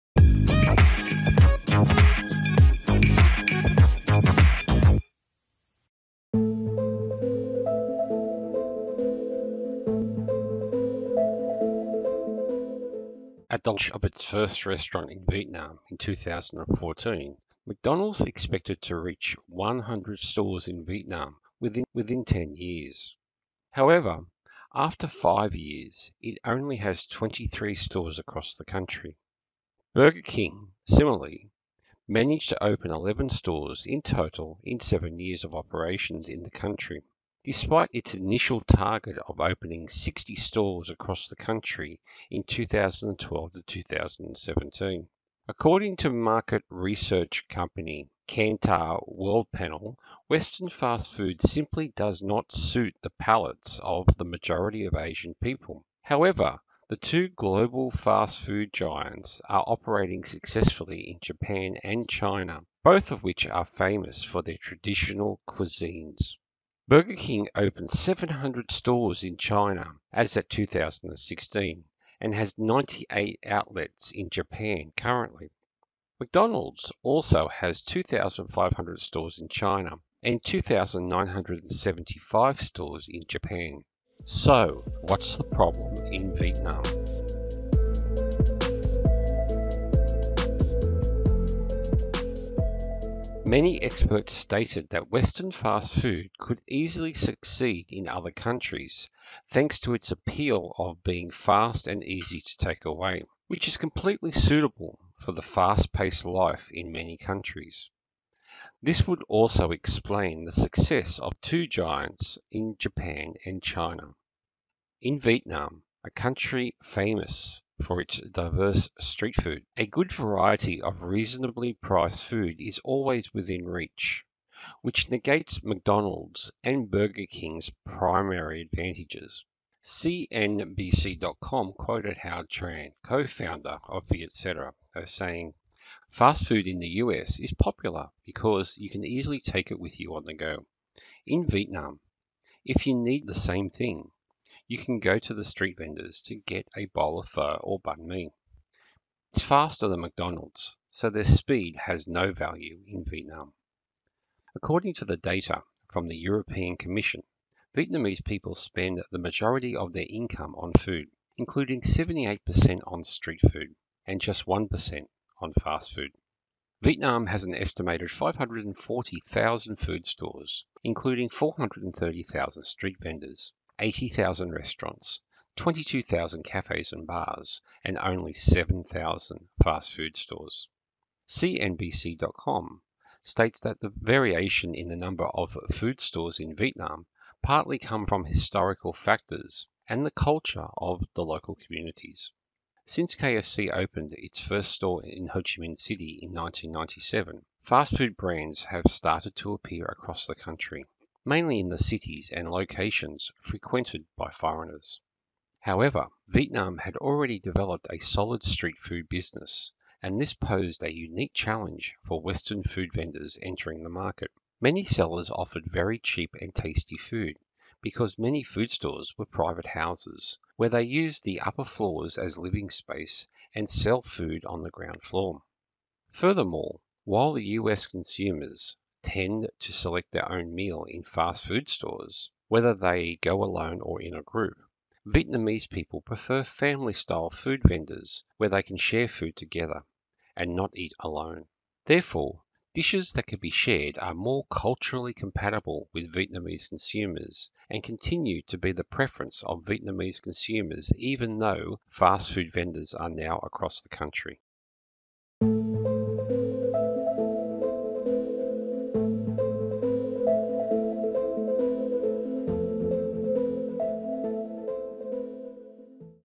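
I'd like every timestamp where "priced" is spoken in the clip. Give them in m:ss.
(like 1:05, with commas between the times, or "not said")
2:01.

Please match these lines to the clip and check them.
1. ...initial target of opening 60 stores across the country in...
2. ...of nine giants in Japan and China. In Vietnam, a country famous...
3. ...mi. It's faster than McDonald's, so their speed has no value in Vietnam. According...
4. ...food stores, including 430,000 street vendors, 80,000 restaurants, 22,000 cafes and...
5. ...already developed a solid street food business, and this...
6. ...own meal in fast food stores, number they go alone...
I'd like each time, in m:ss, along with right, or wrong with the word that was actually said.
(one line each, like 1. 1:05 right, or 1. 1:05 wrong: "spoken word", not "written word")
1. 0:38 right
2. 1:51 wrong: "two", not "nine"
3. 2:28 right
4. 2:49 right
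5. 3:26 right
6. 3:50 wrong: "whether", not "number".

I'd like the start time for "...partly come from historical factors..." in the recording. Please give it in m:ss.
3:07.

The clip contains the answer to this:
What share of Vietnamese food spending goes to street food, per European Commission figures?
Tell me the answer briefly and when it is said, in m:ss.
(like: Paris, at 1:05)
78%, at 2:41.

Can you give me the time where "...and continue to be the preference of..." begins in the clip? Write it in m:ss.
4:07.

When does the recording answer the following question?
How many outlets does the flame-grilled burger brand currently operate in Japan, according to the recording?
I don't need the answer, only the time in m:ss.
1:12.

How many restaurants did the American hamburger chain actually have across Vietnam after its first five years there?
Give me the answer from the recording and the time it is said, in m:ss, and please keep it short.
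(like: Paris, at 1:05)
23, at 0:27.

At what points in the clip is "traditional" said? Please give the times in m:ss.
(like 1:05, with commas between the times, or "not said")
1:04.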